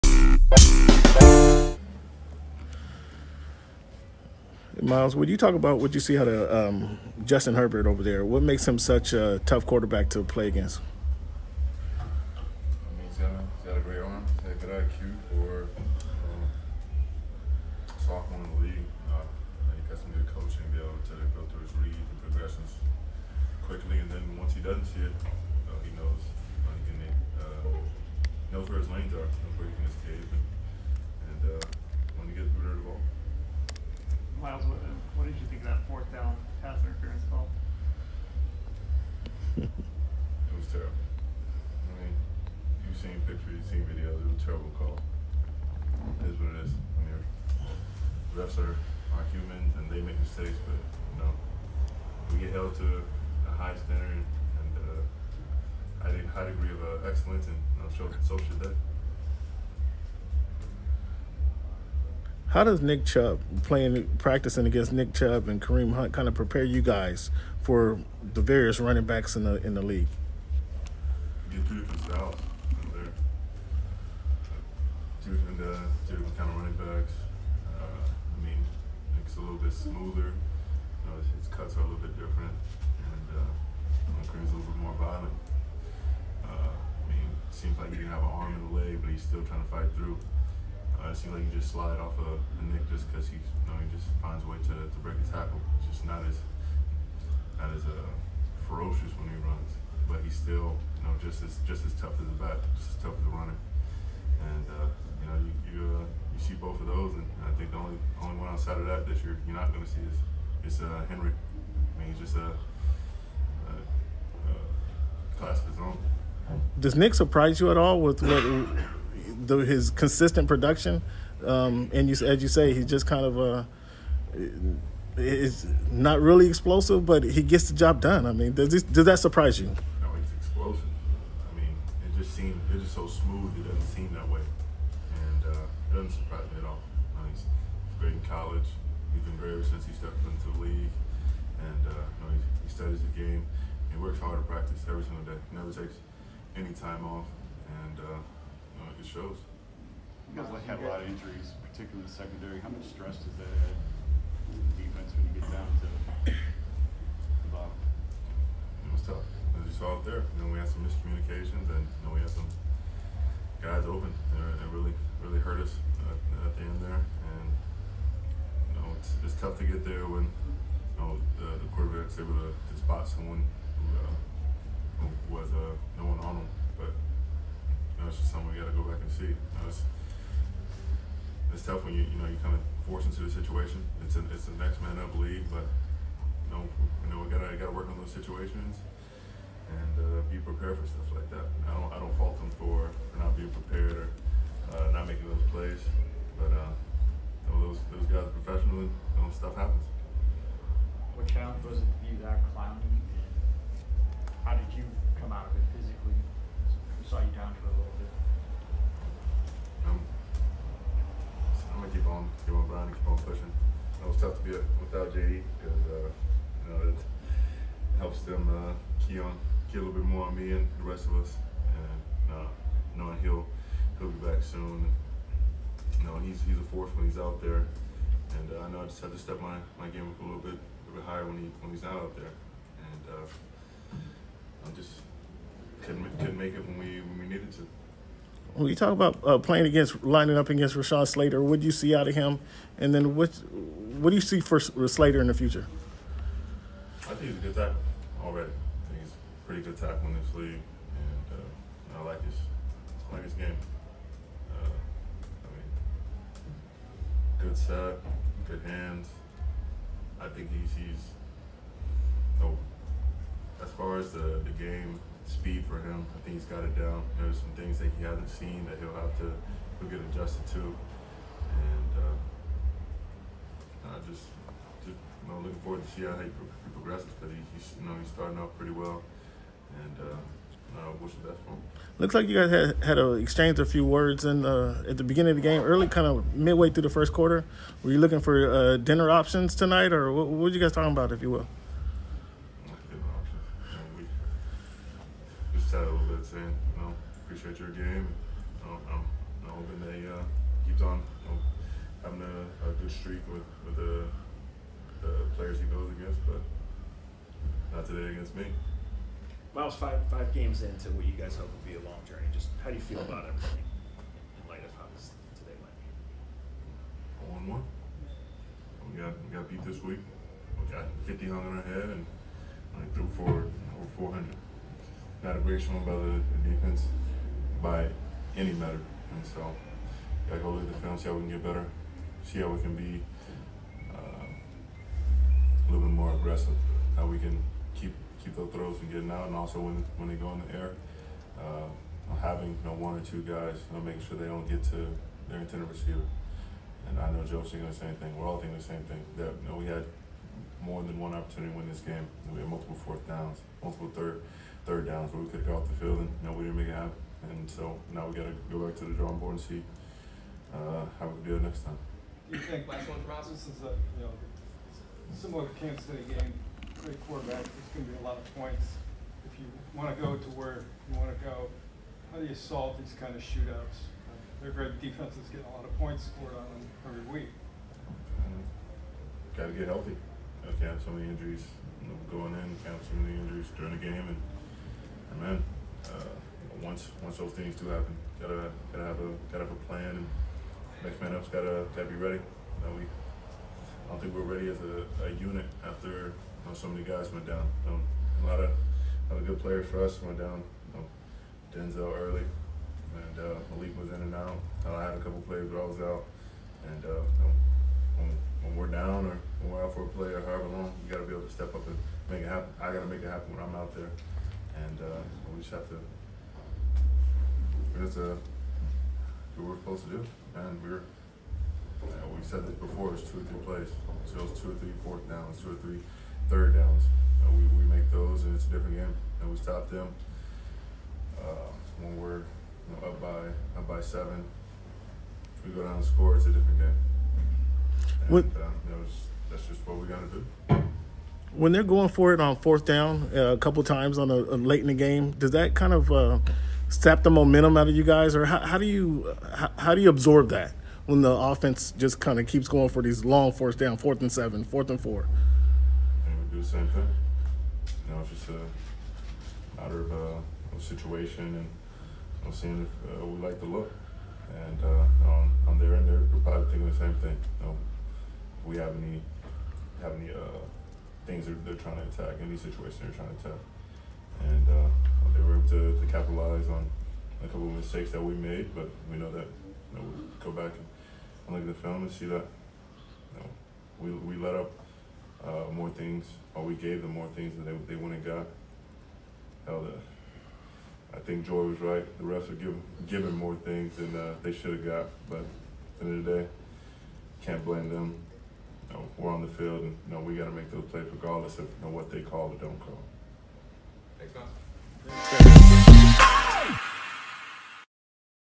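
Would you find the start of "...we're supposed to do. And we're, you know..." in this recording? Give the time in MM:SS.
06:59.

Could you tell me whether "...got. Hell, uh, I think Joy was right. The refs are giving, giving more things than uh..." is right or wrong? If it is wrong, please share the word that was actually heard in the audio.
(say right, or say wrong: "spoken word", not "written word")
right.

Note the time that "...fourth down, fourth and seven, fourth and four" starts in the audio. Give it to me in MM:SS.
07:33.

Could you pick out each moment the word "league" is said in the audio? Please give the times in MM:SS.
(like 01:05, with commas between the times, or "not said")
00:18, 01:09, 02:20, 03:05, 04:10.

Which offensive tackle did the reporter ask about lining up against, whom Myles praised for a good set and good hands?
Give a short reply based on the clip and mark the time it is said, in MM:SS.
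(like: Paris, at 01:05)
Rashawn Slater, at 04:00.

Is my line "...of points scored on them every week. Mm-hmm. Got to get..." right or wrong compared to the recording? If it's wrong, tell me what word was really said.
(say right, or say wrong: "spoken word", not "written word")
right.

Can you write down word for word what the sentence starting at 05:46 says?
And I know Joe's thinking the same thing.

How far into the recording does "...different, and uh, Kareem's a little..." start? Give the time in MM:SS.
01:22.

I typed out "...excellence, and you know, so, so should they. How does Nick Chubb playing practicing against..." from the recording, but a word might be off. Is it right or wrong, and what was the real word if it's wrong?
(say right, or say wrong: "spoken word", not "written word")
right.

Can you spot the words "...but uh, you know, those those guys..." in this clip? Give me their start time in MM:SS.
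03:16.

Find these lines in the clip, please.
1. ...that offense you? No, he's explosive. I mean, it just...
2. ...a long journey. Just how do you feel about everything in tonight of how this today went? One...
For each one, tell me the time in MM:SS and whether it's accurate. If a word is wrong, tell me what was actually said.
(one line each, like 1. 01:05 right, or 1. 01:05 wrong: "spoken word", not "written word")
1. 02:09 wrong: "surprise", not "offense"
2. 05:11 wrong: "light", not "tonight".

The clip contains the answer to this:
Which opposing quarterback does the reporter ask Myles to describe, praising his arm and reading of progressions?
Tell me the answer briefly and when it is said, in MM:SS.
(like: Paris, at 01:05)
Justin Herbert, at 00:07.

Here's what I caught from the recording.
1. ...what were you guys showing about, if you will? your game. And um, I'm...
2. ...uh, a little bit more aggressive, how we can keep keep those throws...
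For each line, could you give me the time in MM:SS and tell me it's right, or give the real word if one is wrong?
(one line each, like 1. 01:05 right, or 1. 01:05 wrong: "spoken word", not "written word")
1. 04:50 wrong: "talking", not "showing"
2. 05:33 right.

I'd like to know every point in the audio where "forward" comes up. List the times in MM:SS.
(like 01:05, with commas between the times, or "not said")
04:35.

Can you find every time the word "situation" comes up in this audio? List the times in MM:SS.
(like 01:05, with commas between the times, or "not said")
03:03, 03:08, 07:40, 07:52.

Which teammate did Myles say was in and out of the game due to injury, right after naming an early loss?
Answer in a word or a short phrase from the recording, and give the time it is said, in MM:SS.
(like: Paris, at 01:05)
Malik, at 06:43.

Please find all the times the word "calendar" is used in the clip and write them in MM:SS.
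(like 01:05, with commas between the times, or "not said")
not said.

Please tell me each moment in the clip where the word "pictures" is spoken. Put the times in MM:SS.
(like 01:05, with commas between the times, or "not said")
00:43.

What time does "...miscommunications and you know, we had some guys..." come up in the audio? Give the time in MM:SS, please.
02:40.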